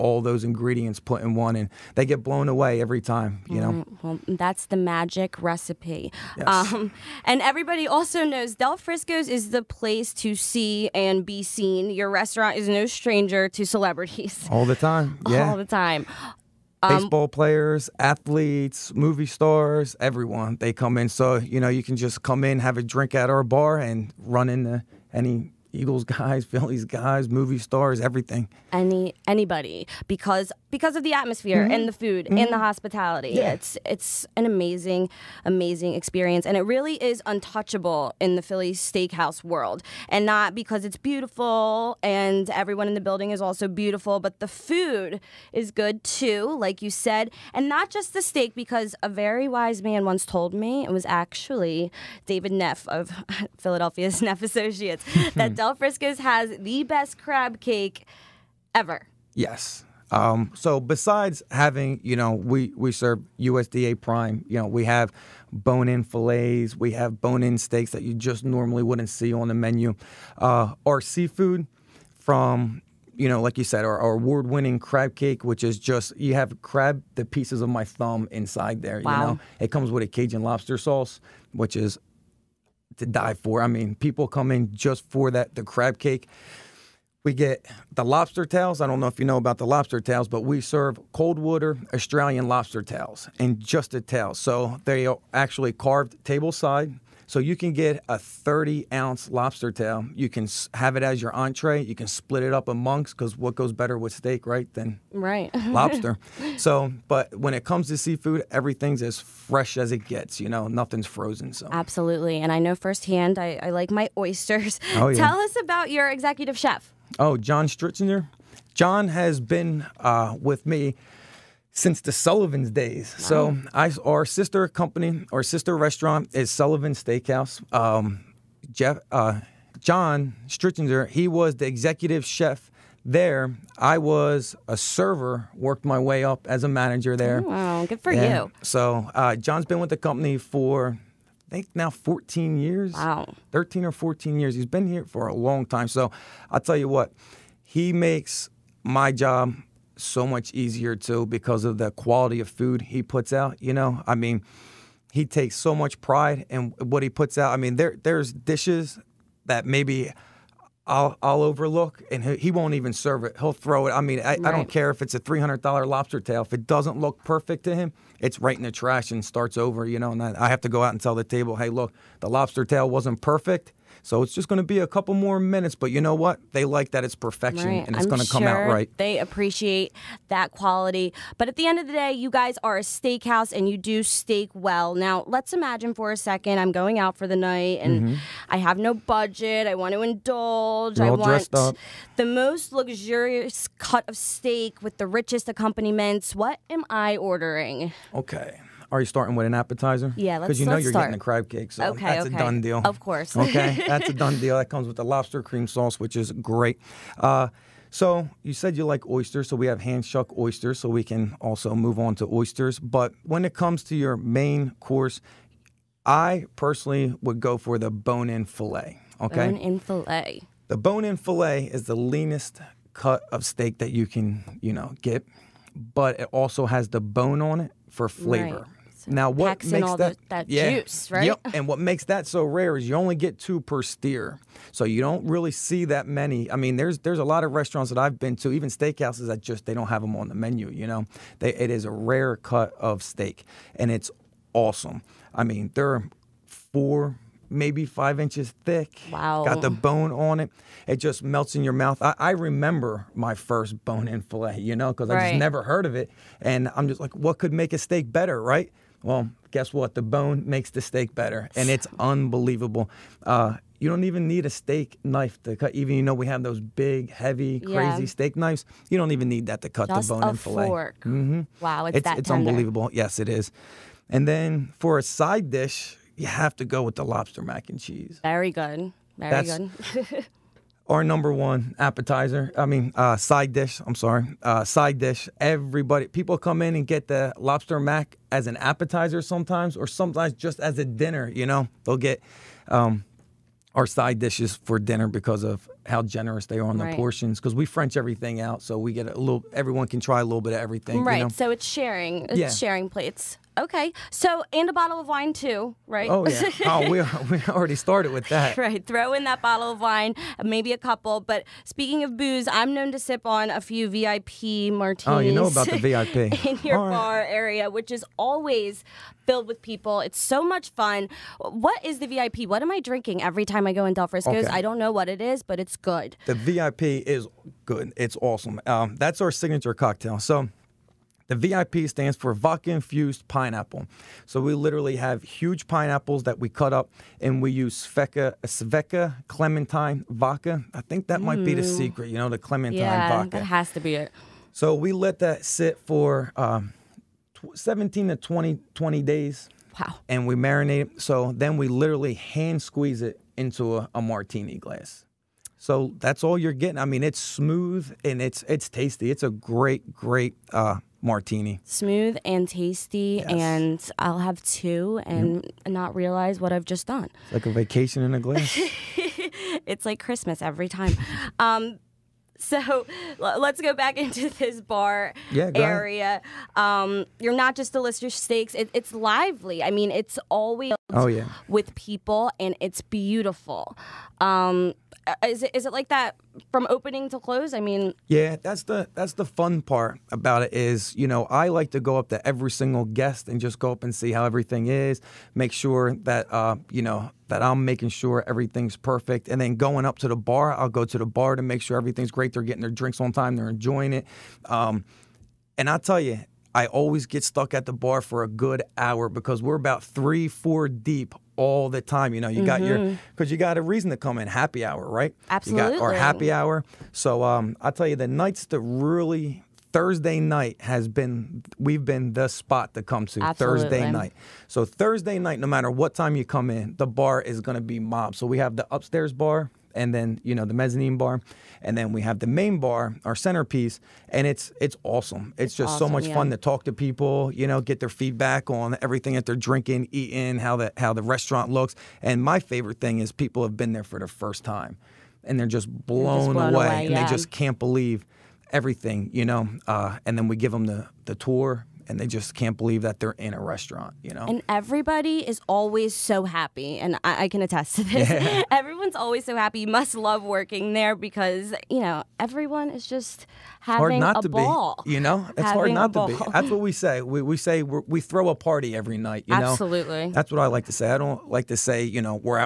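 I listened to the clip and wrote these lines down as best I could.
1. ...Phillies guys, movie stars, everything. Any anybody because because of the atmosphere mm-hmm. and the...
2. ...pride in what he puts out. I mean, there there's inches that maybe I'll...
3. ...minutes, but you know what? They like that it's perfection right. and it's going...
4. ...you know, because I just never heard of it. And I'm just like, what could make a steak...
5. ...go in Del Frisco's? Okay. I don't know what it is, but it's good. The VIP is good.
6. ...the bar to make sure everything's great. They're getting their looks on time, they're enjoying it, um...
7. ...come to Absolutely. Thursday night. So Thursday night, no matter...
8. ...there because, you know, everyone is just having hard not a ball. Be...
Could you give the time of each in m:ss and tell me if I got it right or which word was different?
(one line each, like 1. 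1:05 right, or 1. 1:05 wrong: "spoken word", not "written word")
1. 0:26 right
2. 2:35 wrong: "dishes", not "inches"
3. 2:55 right
4. 4:14 right
5. 5:23 right
6. 6:40 wrong: "drinks", not "looks"
7. 7:02 right
8. 7:40 right.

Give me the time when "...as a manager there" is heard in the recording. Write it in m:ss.
2:16.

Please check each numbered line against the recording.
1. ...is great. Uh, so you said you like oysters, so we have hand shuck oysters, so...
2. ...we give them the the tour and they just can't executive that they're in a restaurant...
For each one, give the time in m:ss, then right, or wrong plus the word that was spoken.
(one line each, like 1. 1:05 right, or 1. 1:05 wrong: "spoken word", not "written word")
1. 3:26 right
2. 7:30 wrong: "believe", not "executive".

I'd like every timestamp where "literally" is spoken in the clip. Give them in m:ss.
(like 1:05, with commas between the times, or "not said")
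5:34, 5:51.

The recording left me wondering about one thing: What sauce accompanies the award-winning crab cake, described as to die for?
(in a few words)
Cajun lobster sauce.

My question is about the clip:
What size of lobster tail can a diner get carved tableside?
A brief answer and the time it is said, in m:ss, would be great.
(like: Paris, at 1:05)
30 ounce, at 1:38.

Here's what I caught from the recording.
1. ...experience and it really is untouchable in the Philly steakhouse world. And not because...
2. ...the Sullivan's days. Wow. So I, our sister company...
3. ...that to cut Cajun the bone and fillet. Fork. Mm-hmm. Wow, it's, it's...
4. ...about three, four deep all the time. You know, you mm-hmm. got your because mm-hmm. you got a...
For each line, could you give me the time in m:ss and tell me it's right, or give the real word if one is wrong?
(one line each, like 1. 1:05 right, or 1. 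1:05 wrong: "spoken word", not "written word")
1. 0:35 right
2. 2:01 right
3. 4:29 wrong: "Just", not "Cajun"
4. 6:49 right.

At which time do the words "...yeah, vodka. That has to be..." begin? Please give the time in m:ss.
5:42.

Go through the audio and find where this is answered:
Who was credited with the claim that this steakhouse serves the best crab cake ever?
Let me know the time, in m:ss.
0:52.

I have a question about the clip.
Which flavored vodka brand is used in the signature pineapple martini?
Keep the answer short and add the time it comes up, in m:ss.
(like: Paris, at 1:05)
Svedka clementine vodka, at 5:38.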